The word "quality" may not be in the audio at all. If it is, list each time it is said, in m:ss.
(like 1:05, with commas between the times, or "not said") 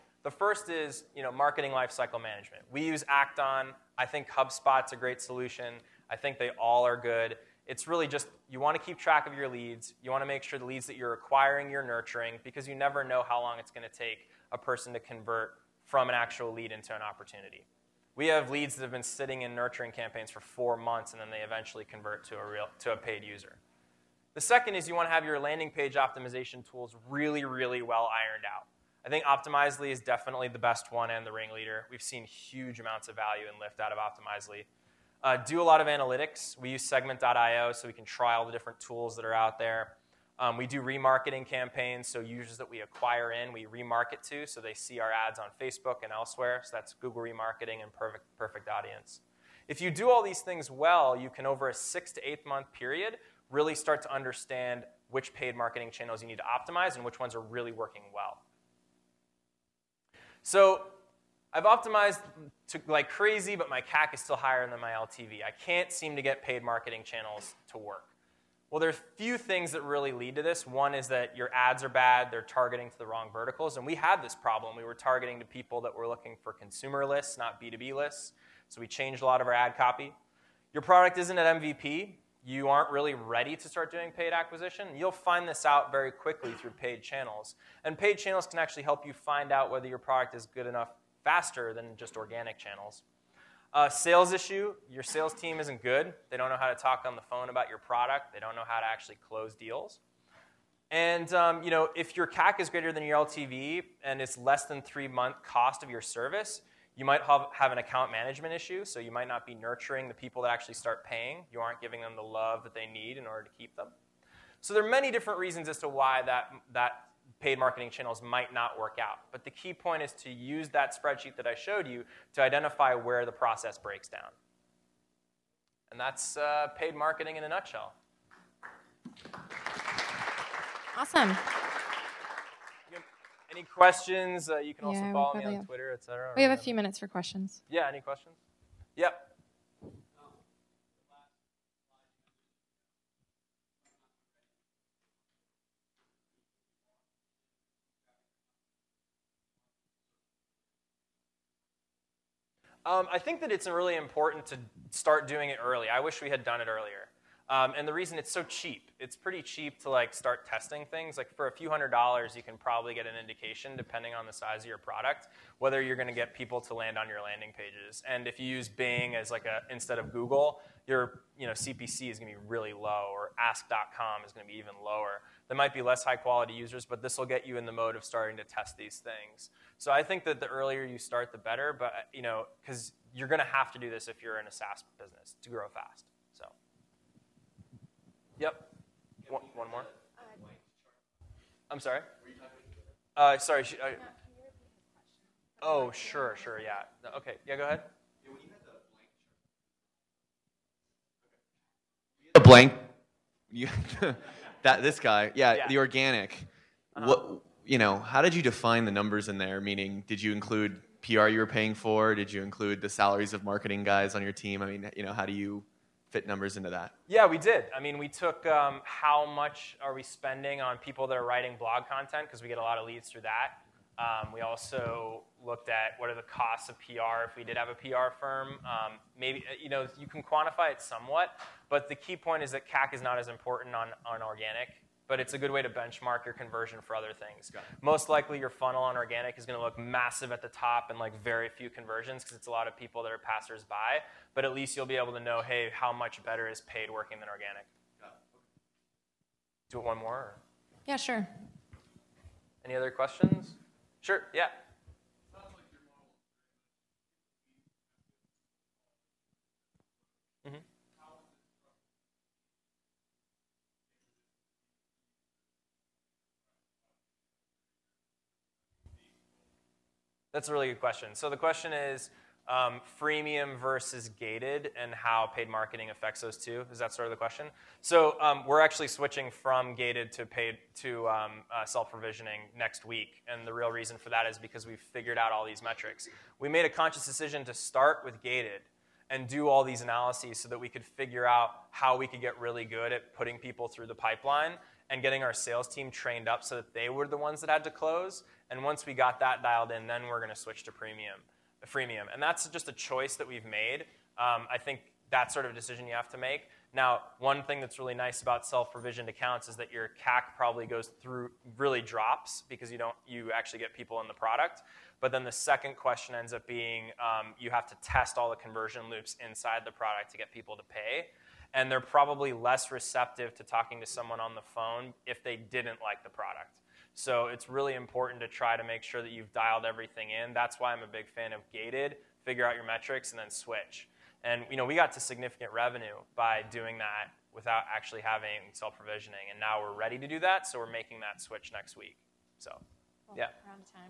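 2:56.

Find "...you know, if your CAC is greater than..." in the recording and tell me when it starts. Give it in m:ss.
1:41.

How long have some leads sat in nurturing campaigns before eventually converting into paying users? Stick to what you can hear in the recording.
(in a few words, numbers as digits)
4 months.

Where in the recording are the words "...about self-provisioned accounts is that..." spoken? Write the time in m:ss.
5:08.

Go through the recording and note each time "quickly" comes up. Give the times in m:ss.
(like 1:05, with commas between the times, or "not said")
1:26.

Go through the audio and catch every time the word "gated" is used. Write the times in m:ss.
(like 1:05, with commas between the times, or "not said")
4:34, 4:39, 4:48, 5:31.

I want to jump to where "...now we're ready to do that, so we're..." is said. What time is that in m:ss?
5:39.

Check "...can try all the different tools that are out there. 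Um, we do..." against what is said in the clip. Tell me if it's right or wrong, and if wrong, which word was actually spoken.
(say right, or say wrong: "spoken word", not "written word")
right.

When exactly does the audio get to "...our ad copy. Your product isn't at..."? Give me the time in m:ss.
1:19.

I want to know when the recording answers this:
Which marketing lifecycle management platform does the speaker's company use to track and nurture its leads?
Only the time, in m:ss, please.
0:03.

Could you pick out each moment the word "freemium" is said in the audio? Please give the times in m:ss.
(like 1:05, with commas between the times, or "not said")
4:32, 5:01.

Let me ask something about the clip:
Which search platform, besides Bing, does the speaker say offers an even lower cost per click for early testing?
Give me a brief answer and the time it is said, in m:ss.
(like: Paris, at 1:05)
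Ask.com, at 2:53.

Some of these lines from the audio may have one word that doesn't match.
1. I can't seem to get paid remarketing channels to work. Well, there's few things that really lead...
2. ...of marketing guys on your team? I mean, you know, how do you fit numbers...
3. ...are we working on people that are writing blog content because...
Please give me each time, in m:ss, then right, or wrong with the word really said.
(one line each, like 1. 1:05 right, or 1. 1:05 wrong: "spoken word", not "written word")
1. 1:05 wrong: "marketing", not "remarketing"
2. 3:33 right
3. 3:39 wrong: "spending", not "working".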